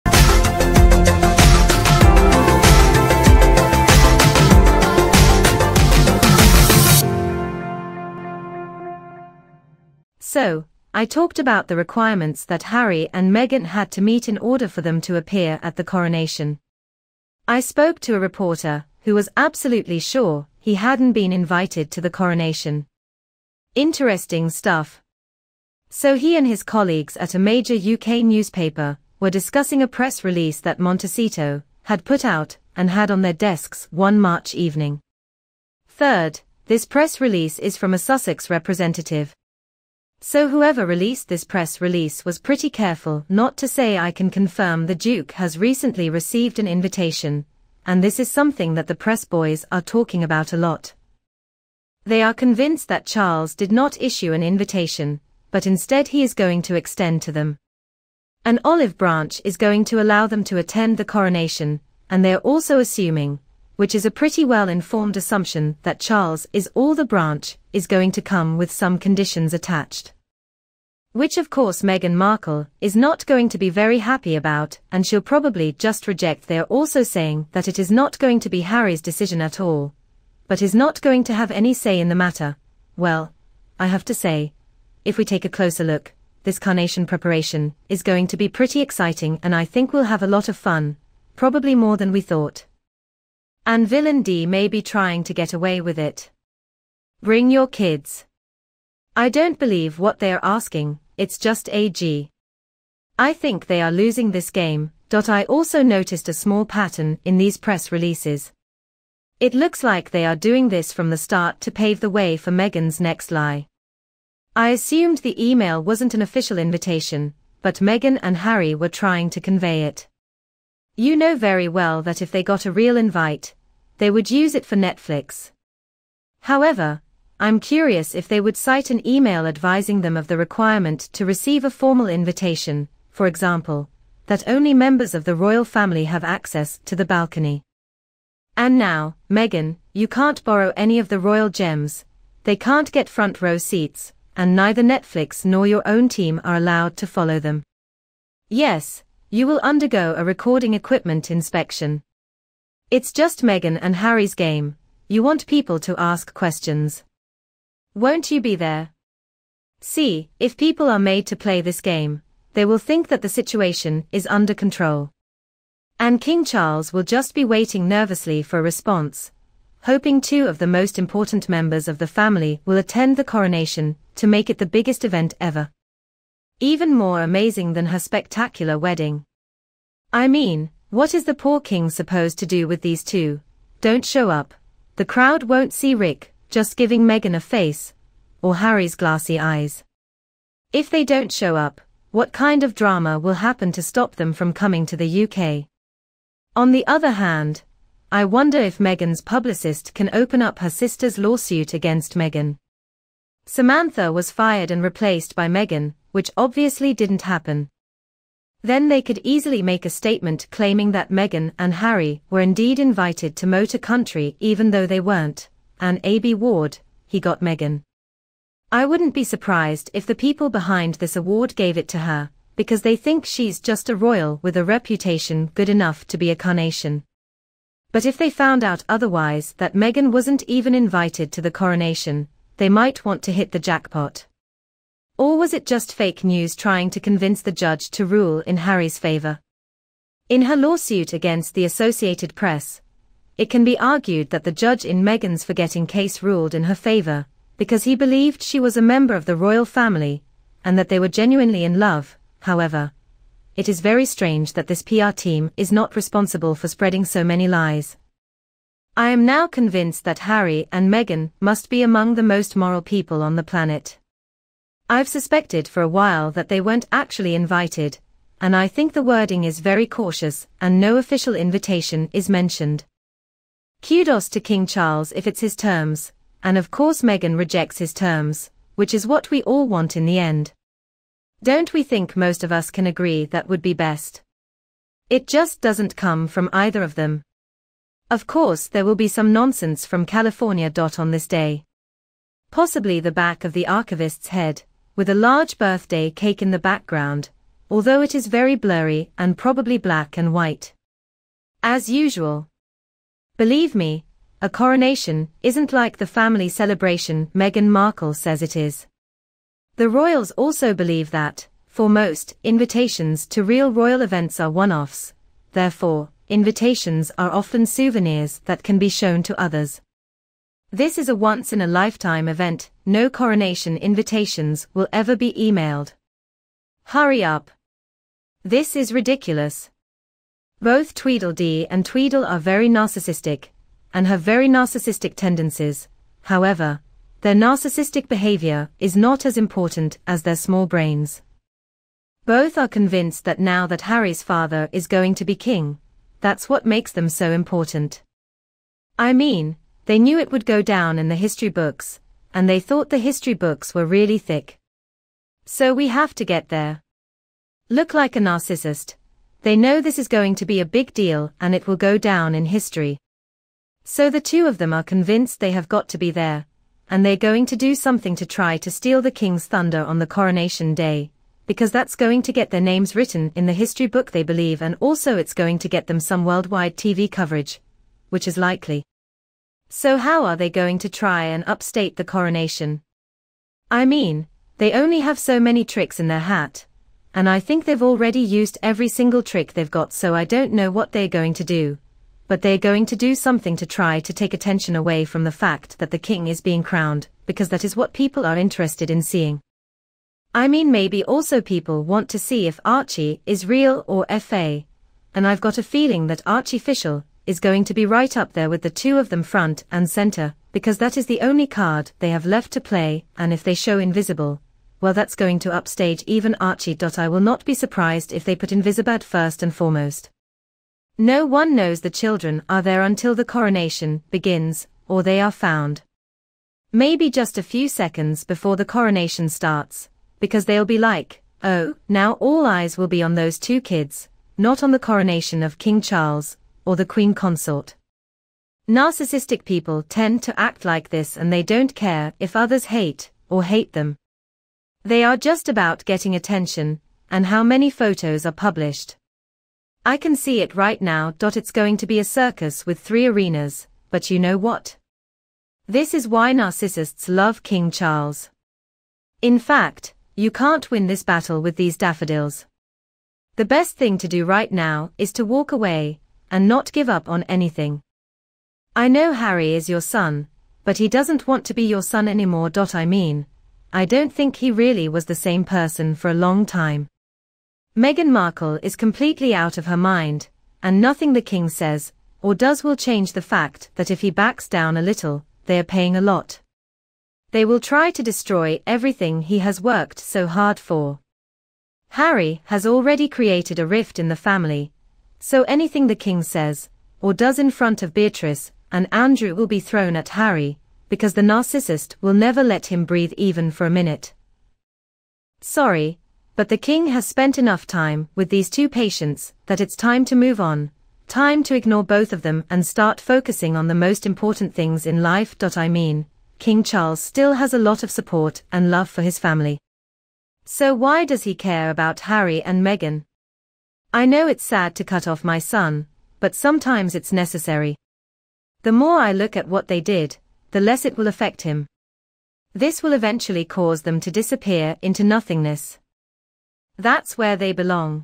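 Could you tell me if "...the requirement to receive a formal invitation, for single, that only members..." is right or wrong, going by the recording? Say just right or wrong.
wrong.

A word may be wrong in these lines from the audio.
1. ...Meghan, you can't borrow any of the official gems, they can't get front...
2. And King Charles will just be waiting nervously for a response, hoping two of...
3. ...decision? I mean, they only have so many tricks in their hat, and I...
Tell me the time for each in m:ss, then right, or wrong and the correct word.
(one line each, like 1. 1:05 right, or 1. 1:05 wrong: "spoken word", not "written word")
1. 2:19 wrong: "royal", not "official"
2. 2:45 right
3. 6:22 wrong: "coronation", not "decision".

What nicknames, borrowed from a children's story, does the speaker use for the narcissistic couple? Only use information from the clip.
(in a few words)
Tweedledee and Tweedle.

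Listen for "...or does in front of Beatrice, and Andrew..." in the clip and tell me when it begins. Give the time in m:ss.
8:16.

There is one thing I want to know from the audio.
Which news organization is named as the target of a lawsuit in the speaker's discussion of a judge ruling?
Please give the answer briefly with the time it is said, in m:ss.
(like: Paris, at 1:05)
Associated Press, at 4:01.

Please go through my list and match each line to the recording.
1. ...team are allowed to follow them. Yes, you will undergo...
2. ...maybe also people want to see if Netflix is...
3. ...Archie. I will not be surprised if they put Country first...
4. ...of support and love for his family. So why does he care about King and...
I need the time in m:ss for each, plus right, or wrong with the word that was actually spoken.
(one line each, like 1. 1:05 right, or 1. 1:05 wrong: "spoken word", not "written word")
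1. 2:26 right
2. 6:40 wrong: "Archie", not "Netflix"
3. 6:56 wrong: "Invisibad", not "Country"
4. 8:37 wrong: "Harry", not "King".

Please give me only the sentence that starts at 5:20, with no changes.
This is a once-in-a-lifetime event, no coronation invitations will ever be emailed.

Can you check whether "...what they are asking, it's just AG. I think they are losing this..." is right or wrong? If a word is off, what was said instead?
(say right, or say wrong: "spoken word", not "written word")
right.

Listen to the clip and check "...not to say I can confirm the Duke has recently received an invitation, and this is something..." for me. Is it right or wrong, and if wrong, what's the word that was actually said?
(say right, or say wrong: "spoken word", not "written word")
right.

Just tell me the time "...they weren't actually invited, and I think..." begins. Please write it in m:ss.
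4:26.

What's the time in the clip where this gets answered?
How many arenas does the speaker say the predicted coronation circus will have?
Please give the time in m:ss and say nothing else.
7:32.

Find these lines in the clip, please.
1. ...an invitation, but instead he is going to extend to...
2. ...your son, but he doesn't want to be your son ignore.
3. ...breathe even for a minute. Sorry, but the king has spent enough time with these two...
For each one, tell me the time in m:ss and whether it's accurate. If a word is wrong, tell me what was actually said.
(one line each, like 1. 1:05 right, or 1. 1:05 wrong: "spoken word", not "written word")
1. 0:54 right
2. 7:49 wrong: "anymore", not "ignore"
3. 8:22 right.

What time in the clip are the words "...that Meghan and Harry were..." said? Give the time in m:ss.
3:30.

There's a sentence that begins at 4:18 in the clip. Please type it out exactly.
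I am now convinced that Harry and Meghan must be among the most moral people on the planet.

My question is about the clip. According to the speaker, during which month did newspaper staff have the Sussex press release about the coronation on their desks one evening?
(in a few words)
March.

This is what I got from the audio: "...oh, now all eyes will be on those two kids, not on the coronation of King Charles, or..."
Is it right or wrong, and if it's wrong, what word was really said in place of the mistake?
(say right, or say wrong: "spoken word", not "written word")
right.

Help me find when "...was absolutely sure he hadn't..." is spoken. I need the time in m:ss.
0:19.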